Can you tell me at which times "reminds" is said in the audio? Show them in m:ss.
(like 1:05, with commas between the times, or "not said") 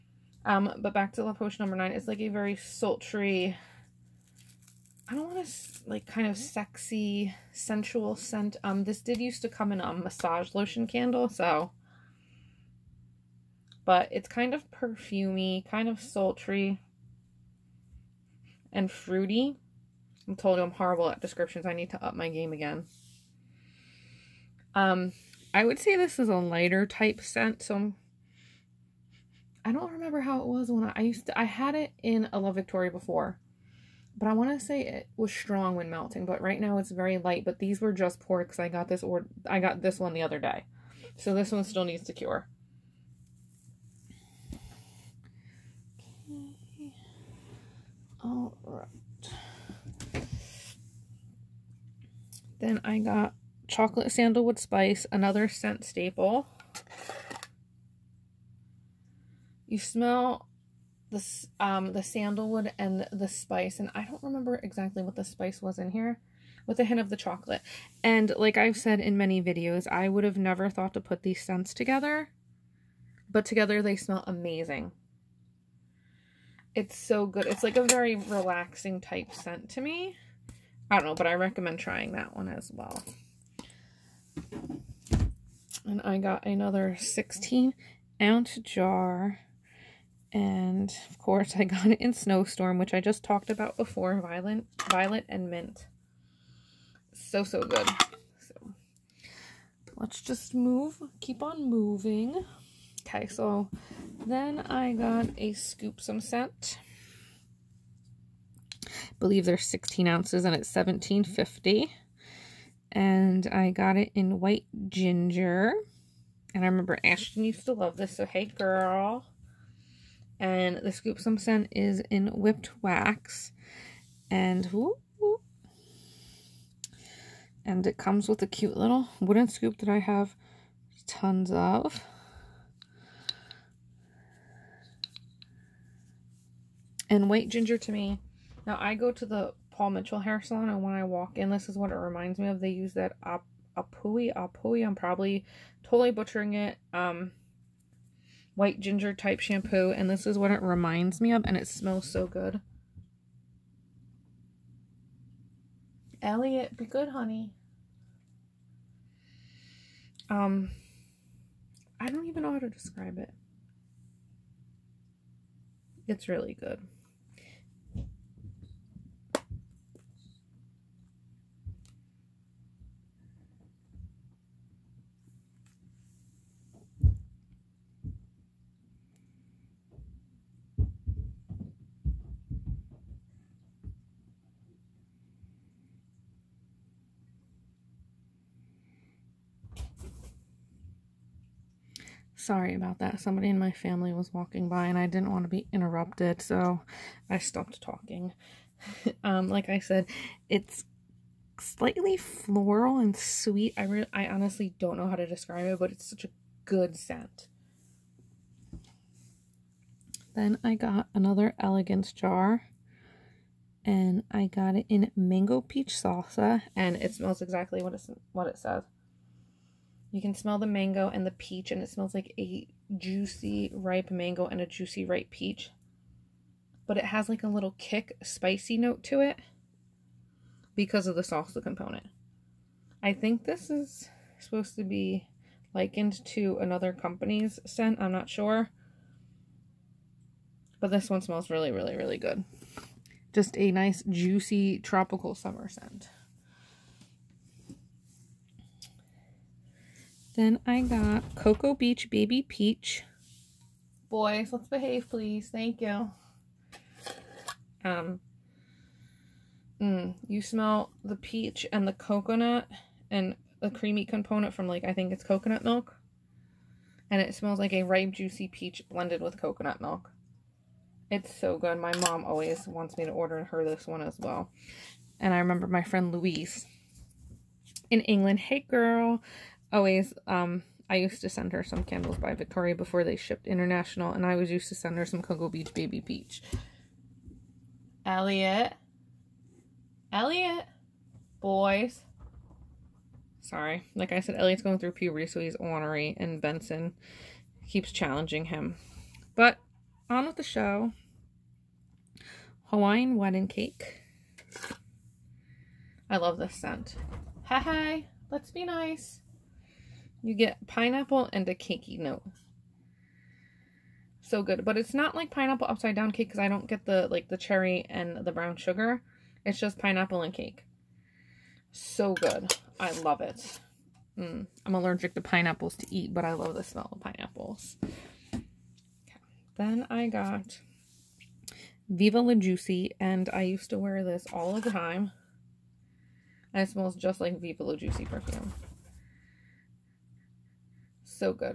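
2:21, 2:30.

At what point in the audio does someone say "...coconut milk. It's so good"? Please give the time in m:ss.
4:29.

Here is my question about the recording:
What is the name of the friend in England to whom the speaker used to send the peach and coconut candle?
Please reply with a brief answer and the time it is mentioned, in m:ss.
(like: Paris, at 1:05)
Louise, at 4:36.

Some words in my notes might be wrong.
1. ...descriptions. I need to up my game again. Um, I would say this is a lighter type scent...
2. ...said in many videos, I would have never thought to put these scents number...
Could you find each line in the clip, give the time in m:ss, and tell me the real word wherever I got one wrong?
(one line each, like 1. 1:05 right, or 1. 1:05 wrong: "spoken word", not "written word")
1. 0:21 right
2. 1:08 wrong: "together", not "number".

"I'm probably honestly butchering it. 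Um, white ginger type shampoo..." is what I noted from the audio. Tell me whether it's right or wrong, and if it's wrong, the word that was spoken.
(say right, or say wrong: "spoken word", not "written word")
wrong: "totally", not "honestly".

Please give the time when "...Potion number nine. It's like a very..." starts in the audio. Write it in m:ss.
0:01.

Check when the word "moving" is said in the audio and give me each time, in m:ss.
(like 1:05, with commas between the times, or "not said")
1:41.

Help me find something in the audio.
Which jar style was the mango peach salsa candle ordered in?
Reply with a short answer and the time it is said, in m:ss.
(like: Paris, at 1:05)
Elegance, at 3:31.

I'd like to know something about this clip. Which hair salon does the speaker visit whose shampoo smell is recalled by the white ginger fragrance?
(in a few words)
Paul Mitchell.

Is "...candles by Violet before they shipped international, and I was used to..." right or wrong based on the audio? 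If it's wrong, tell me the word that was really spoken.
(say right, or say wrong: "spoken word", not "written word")
wrong: "Victoria", not "Violet".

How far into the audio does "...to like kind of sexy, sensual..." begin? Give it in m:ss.
0:05.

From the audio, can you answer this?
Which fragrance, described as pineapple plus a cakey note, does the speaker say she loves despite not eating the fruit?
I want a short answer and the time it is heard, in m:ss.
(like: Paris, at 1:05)
Hawaiian wedding cake, at 5:02.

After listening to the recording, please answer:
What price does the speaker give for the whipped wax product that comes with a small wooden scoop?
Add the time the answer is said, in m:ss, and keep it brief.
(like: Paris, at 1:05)
$17.50, at 1:50.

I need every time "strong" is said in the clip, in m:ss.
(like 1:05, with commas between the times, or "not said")
0:35.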